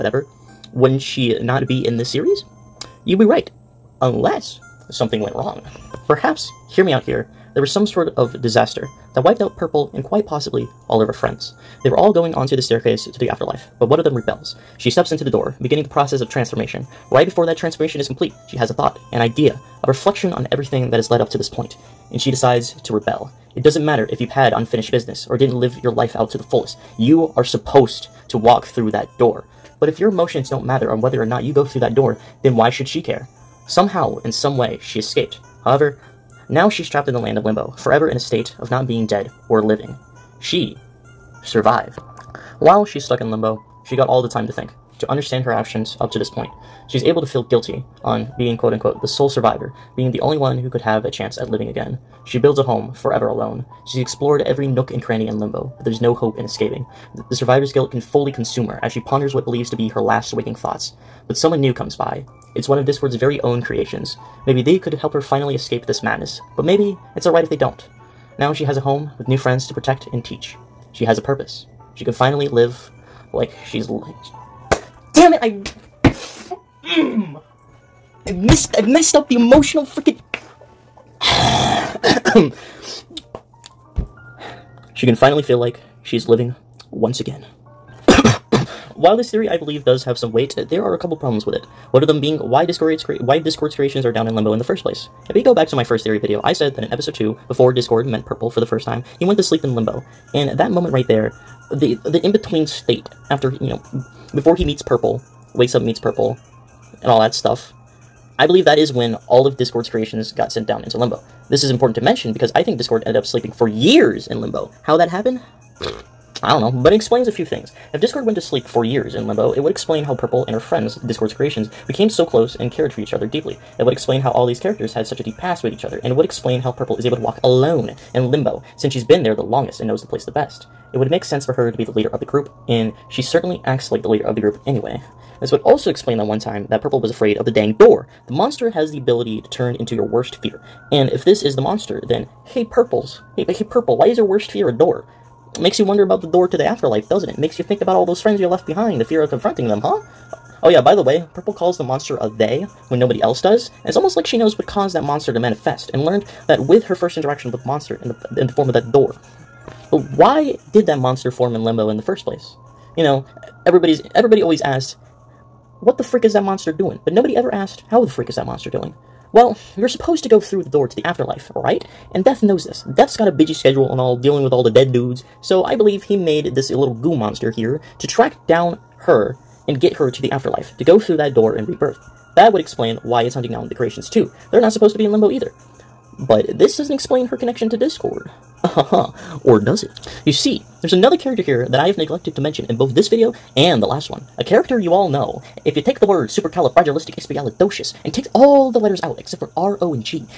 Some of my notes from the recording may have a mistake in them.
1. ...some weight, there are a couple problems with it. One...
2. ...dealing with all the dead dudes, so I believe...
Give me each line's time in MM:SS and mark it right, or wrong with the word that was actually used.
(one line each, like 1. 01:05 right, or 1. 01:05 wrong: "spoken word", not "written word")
1. 01:30 right
2. 02:54 right.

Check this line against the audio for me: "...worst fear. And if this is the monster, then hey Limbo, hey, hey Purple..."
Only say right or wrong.
wrong.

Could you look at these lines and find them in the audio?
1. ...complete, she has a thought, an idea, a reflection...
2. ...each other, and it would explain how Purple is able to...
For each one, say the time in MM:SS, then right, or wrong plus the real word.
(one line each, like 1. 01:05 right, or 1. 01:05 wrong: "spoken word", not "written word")
1. 00:18 right
2. 02:05 right.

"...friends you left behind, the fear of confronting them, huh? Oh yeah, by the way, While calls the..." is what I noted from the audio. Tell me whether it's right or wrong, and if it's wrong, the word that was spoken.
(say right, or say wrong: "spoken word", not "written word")
wrong: "Purple", not "While".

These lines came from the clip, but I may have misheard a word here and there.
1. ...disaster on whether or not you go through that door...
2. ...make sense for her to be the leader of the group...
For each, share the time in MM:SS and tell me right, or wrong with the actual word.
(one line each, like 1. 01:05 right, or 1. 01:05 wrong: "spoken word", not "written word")
1. 00:30 wrong: "matter", not "disaster"
2. 02:11 right.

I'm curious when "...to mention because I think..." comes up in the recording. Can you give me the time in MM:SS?
01:51.